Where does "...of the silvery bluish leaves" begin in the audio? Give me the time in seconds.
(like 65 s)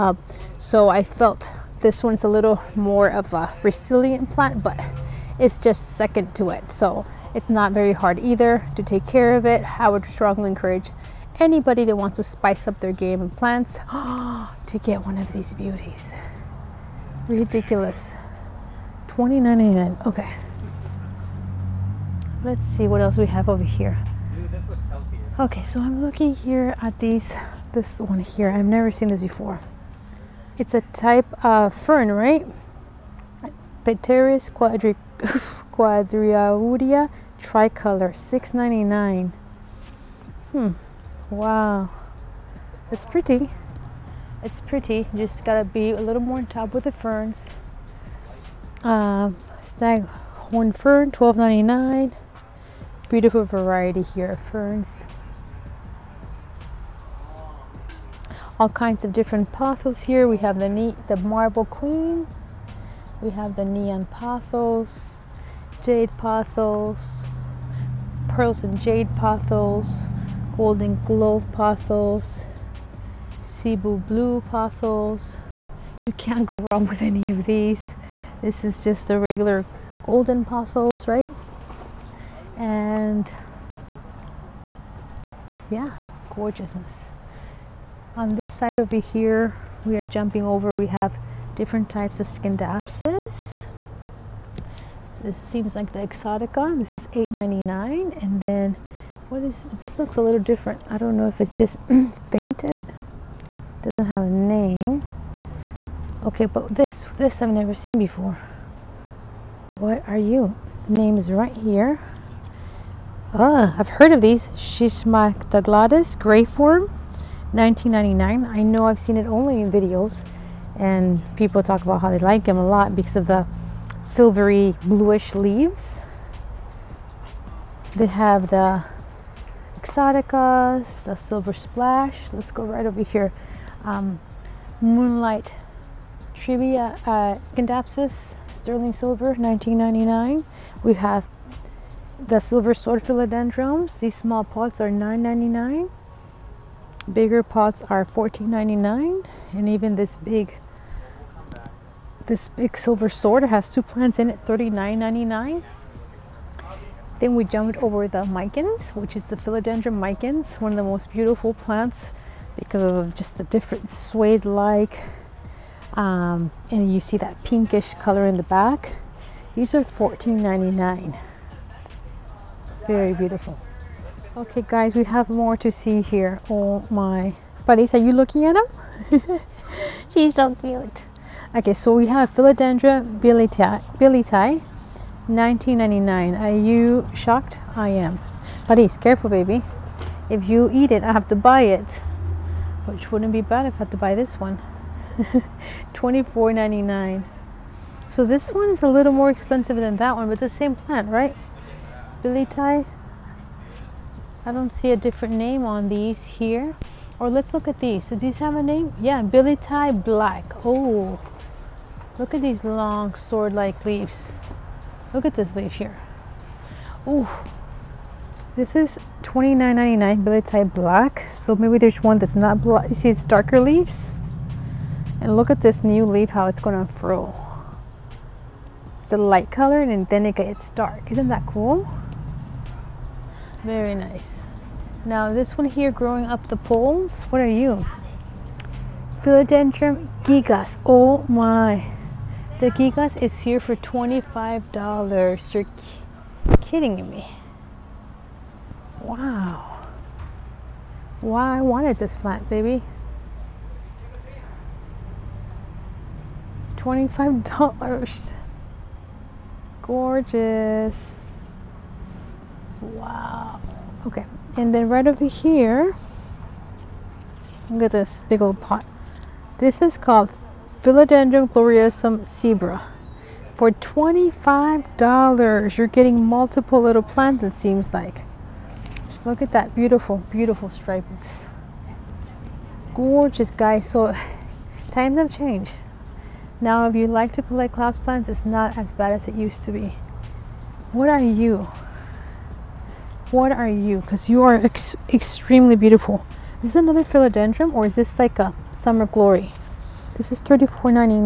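123 s.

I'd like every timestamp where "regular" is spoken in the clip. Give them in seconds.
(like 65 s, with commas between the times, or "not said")
79 s.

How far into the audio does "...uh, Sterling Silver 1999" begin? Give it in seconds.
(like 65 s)
137 s.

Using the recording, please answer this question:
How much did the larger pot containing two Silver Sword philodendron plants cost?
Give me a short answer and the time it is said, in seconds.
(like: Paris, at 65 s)
$39.99, at 154 s.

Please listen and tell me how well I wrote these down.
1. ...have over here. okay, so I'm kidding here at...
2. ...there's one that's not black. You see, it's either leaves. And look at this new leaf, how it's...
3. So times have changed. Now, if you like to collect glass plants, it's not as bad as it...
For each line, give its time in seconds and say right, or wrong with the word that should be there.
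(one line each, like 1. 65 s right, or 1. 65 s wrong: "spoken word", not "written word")
1. 23 s wrong: "looking", not "kidding"
2. 221 s wrong: "darker", not "either"
3. 283 s right.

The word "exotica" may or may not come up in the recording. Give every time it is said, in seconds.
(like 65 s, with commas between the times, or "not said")
95 s, 129 s.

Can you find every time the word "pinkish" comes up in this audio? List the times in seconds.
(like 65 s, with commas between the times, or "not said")
167 s.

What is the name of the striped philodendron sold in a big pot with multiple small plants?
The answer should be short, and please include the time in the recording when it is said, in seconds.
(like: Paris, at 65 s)
Philodendron gloriosum Zebra, at 270 s.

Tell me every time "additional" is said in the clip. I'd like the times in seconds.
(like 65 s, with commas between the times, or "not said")
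not said.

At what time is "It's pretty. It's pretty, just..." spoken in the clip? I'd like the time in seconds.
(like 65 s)
42 s.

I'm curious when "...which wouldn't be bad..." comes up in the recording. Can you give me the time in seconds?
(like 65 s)
192 s.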